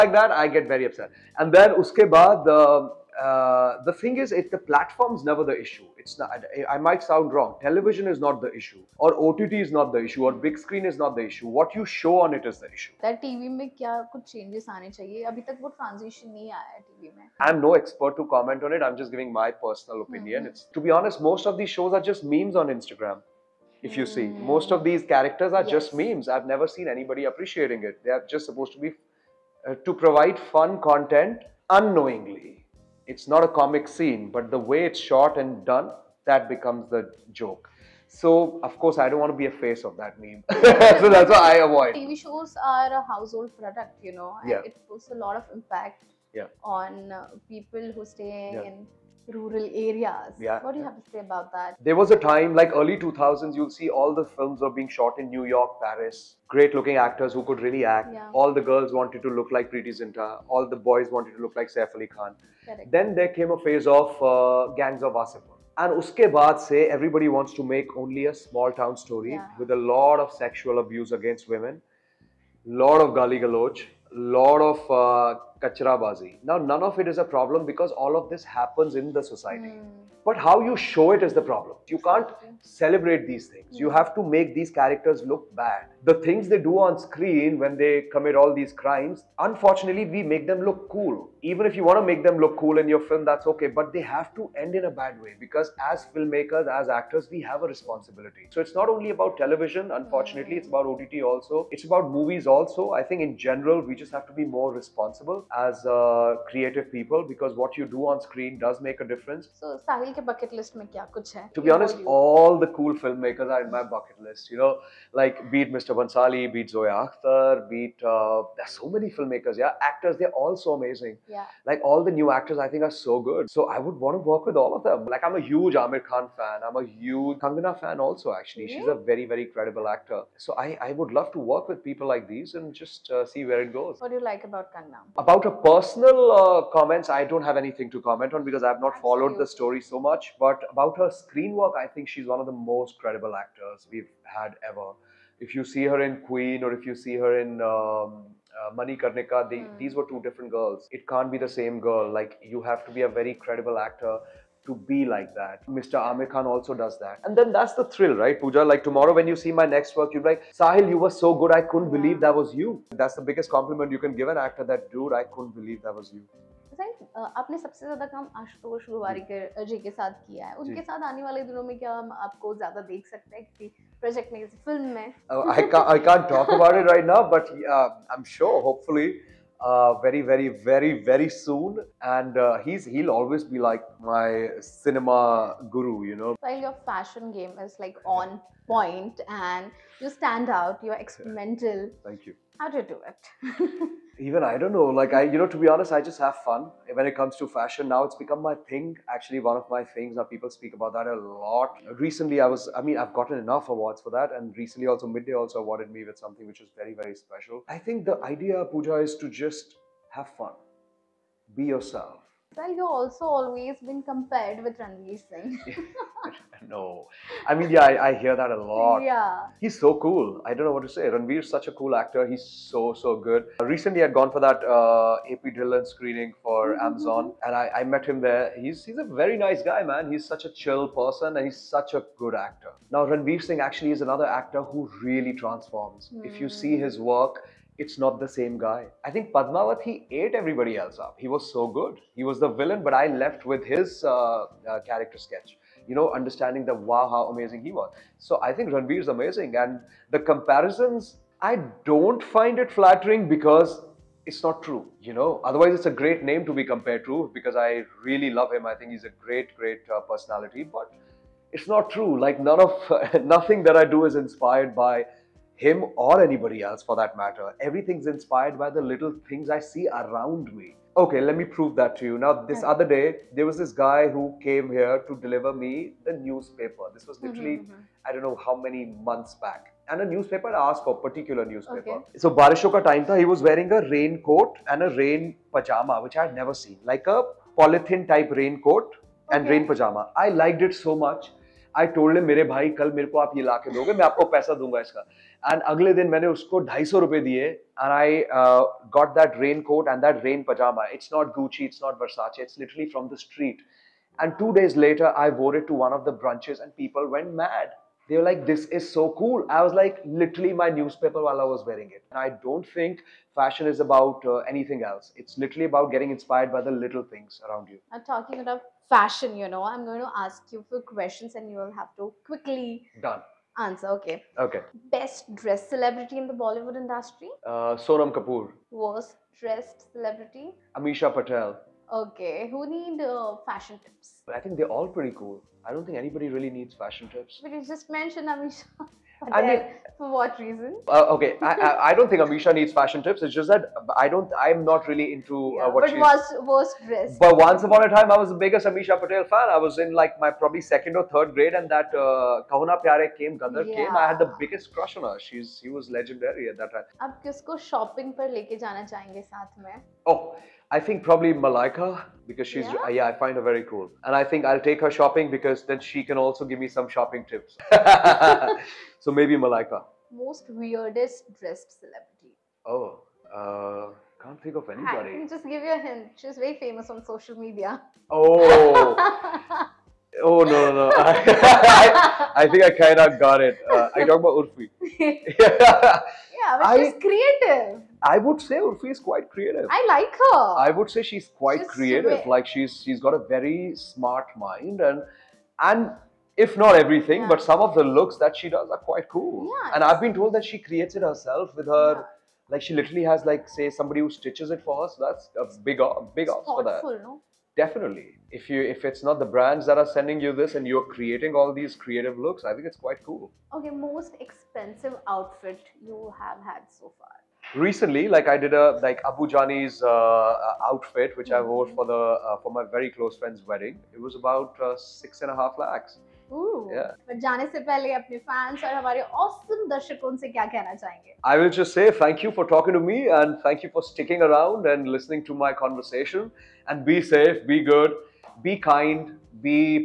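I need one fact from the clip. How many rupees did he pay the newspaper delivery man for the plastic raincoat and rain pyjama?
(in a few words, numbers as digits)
250.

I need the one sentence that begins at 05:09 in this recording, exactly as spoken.
I was like, literally, my newspaper while I was wearing it.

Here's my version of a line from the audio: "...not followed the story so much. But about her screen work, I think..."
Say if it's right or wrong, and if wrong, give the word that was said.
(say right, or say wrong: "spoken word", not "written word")
right.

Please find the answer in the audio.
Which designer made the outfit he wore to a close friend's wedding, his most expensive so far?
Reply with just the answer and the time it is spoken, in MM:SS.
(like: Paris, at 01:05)
Abu Jani, at 06:59.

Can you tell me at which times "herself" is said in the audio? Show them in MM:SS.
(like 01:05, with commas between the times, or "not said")
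06:41.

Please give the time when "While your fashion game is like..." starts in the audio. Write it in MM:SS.
03:06.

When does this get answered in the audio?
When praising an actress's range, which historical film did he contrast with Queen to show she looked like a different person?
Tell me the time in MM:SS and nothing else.
02:28.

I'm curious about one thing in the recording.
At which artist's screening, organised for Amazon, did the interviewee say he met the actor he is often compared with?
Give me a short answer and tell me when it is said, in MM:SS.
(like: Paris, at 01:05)
AP Dhillon, at 03:45.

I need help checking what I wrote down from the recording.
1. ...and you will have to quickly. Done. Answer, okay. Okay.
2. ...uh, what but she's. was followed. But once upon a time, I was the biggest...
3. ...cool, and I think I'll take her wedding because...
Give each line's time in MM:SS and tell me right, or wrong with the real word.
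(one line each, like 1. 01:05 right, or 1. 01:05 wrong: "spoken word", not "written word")
1. 05:21 right
2. 05:45 wrong: "dressed", not "followed"
3. 06:03 wrong: "shopping", not "wedding".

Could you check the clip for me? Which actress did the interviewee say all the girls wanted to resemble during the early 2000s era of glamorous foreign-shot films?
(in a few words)
Preity Zinta.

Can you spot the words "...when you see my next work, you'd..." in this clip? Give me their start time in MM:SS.
02:39.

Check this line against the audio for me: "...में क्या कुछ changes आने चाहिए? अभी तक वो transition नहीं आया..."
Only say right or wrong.
right.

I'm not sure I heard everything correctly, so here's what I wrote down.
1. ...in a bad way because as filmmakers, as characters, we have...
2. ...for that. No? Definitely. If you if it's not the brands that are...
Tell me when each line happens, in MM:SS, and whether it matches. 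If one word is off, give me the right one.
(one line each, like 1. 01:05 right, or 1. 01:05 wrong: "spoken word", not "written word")
1. 01:34 wrong: "actors", not "characters"
2. 06:46 right.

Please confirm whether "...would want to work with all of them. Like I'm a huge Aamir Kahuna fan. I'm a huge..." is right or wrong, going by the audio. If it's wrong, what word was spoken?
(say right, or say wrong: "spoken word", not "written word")
wrong: "Khan", not "Kahuna".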